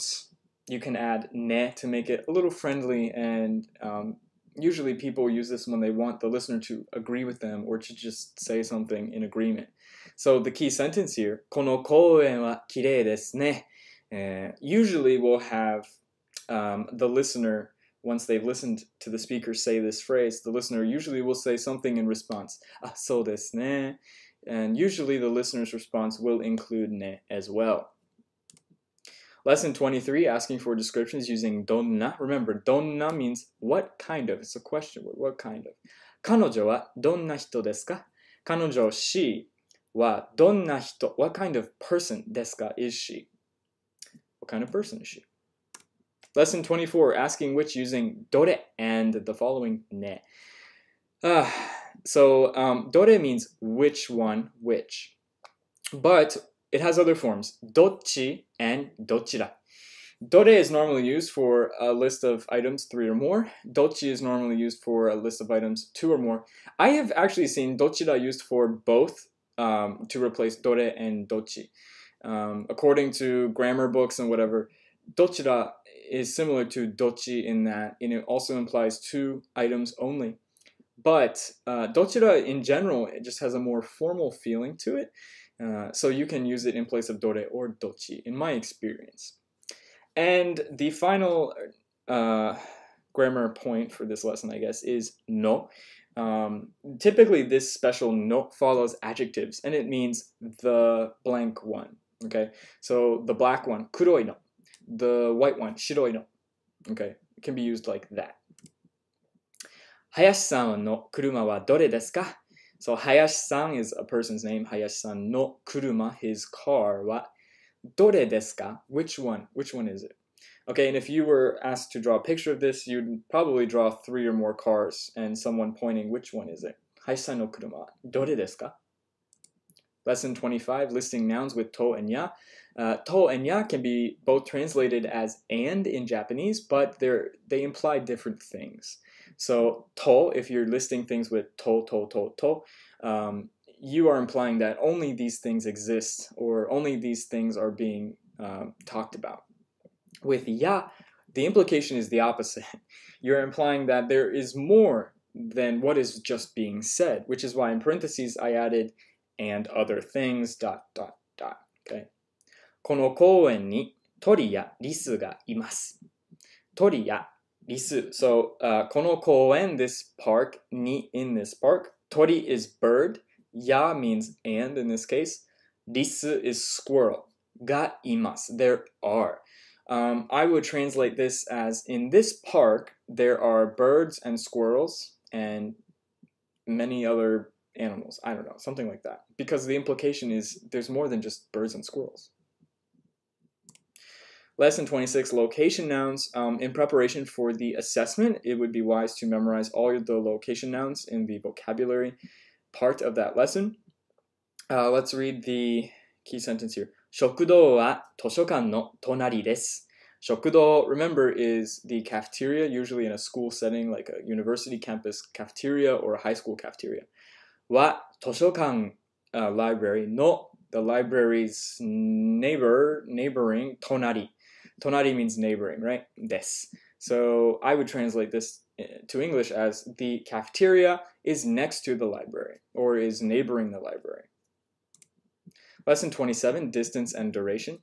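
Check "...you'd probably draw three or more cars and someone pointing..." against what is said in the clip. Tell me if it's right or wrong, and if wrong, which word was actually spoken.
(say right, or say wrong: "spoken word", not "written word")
right.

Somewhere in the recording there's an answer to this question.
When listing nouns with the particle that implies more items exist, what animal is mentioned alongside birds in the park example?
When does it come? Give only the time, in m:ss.
2:56.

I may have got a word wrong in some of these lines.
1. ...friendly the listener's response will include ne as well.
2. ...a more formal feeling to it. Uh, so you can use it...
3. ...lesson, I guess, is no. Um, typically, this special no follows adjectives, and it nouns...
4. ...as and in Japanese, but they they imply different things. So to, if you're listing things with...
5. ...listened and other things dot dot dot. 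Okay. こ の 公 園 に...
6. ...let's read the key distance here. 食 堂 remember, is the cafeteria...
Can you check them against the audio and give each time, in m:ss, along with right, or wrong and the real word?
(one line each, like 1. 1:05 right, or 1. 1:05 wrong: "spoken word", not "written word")
1. 0:24 wrong: "usually", not "friendly"
2. 1:23 right
3. 1:34 wrong: "means", not "nouns"
4. 2:15 right
5. 2:38 wrong: "added", not "listened"
6. 3:24 wrong: "sentence", not "distance".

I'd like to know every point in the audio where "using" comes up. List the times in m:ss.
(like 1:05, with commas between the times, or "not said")
0:31, 0:47.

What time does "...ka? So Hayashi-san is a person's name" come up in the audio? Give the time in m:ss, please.
1:52.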